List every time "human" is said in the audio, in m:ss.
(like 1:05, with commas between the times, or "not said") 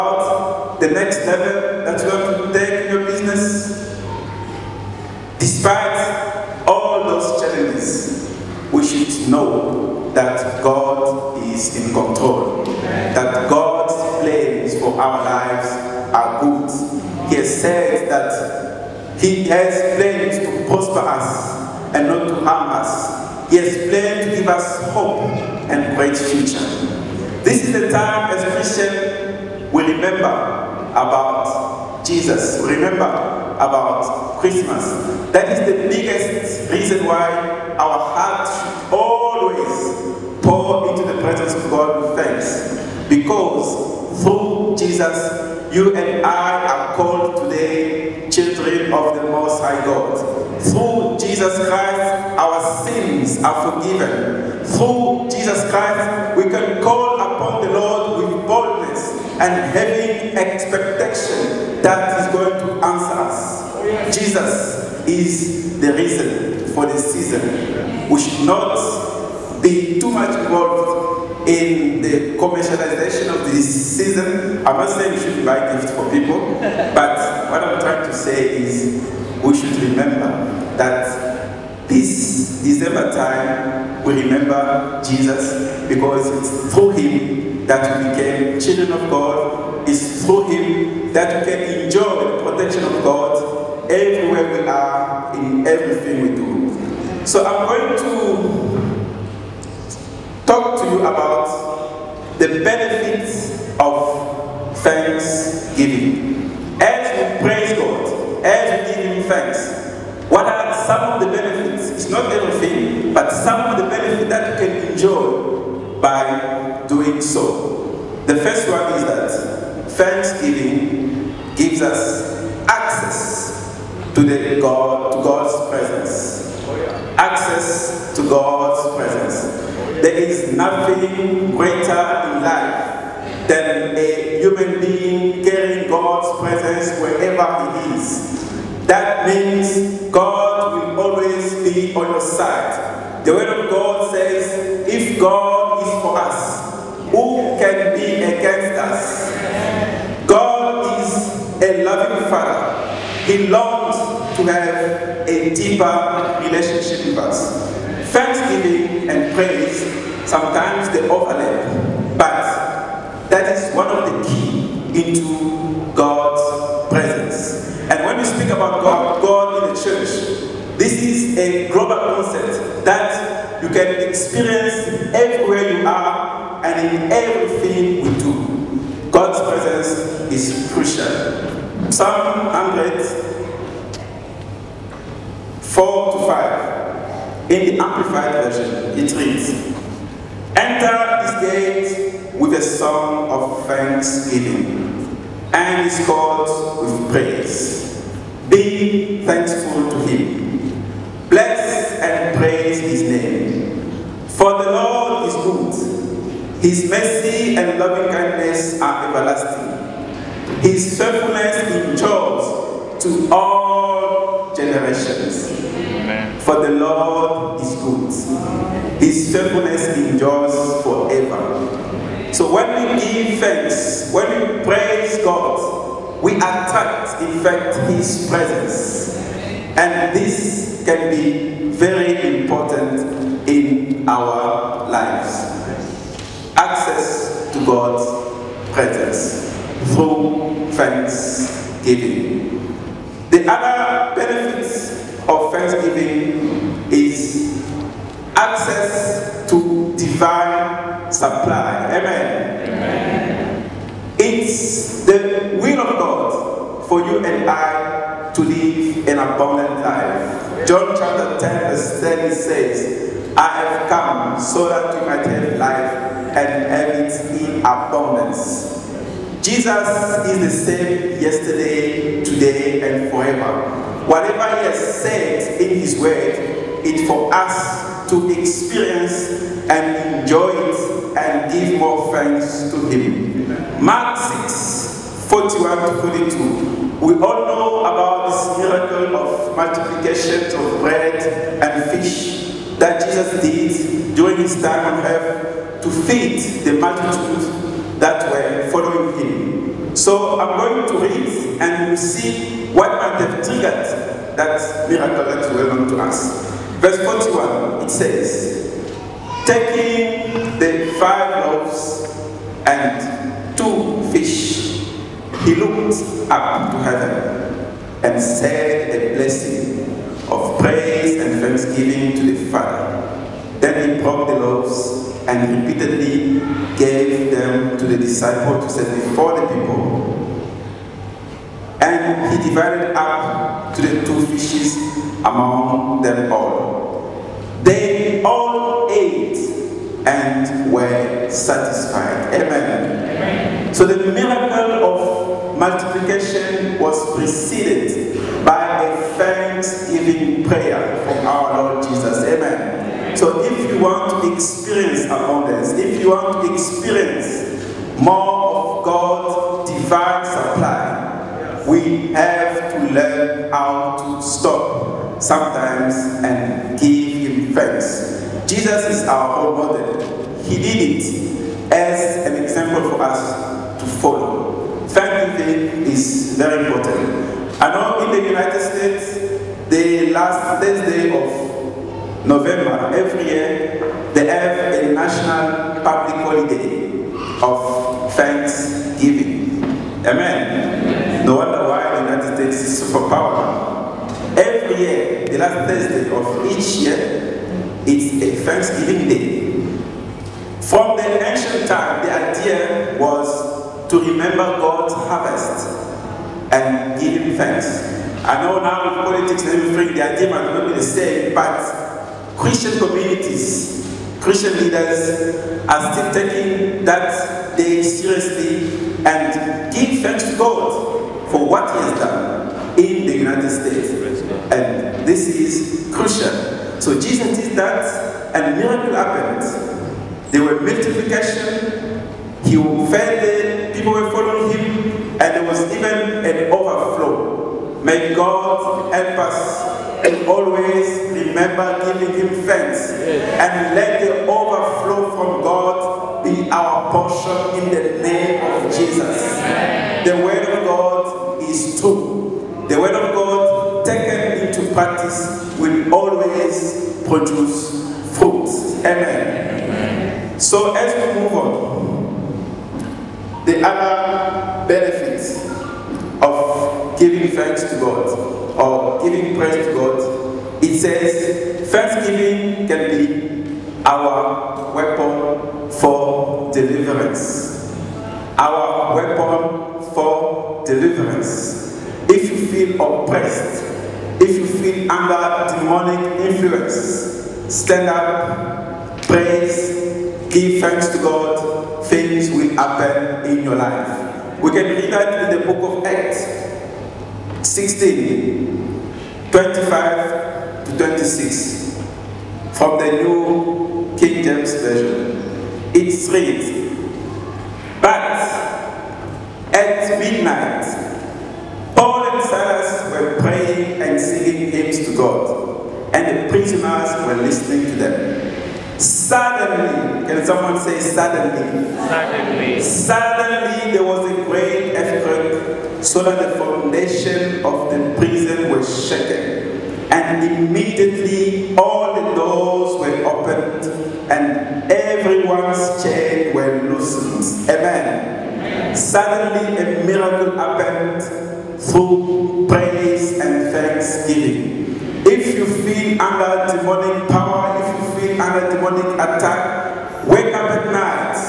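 2:14.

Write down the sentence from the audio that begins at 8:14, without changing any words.
We can read that in the book of Acts 16, 25 to 26 from the New King James Version.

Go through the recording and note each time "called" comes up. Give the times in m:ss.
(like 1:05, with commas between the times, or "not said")
0:46, 3:16.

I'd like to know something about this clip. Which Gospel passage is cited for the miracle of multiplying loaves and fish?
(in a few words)
Mark 6:41-42.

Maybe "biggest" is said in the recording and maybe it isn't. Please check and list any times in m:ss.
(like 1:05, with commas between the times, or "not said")
0:35.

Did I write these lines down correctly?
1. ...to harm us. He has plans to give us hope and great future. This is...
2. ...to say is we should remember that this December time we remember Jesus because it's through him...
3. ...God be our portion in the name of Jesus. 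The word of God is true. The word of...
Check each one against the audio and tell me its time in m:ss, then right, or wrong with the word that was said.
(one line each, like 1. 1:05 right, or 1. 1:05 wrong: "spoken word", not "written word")
1. 0:22 right
2. 1:18 right
3. 7:25 right.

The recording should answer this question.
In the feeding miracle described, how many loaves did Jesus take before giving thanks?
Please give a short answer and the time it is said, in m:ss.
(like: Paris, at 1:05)
5, at 5:10.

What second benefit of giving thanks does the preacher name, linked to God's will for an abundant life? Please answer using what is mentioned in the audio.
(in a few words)
Access to divine supply.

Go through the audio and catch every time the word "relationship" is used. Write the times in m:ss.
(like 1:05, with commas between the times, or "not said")
2:36.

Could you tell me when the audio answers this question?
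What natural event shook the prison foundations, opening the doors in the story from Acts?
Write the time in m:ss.
8:44.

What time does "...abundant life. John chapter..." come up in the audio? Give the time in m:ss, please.
4:19.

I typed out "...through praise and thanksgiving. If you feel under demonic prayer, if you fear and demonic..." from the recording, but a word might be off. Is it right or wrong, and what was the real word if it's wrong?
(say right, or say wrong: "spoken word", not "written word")
wrong: "power", not "prayer".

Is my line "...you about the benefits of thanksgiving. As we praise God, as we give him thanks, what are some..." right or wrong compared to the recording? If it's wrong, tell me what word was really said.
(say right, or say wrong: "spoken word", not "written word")
right.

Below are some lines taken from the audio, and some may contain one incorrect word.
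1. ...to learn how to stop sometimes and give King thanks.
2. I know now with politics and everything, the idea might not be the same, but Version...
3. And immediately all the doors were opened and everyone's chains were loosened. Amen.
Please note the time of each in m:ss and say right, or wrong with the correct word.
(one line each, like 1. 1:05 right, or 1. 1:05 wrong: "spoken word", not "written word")
1. 6:02 wrong: "Him", not "King"
2. 6:48 wrong: "Christian", not "Version"
3. 8:49 right.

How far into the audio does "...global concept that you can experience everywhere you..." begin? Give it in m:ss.
2:51.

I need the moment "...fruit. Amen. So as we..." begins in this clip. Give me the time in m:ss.
7:38.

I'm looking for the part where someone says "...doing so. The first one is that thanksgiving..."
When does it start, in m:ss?
1:57.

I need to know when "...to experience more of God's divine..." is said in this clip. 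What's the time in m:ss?
5:56.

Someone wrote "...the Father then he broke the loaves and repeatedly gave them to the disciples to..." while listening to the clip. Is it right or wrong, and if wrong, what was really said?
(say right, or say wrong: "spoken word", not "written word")
right.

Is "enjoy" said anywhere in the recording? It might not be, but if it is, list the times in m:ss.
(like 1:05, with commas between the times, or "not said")
1:31, 1:54, 4:40.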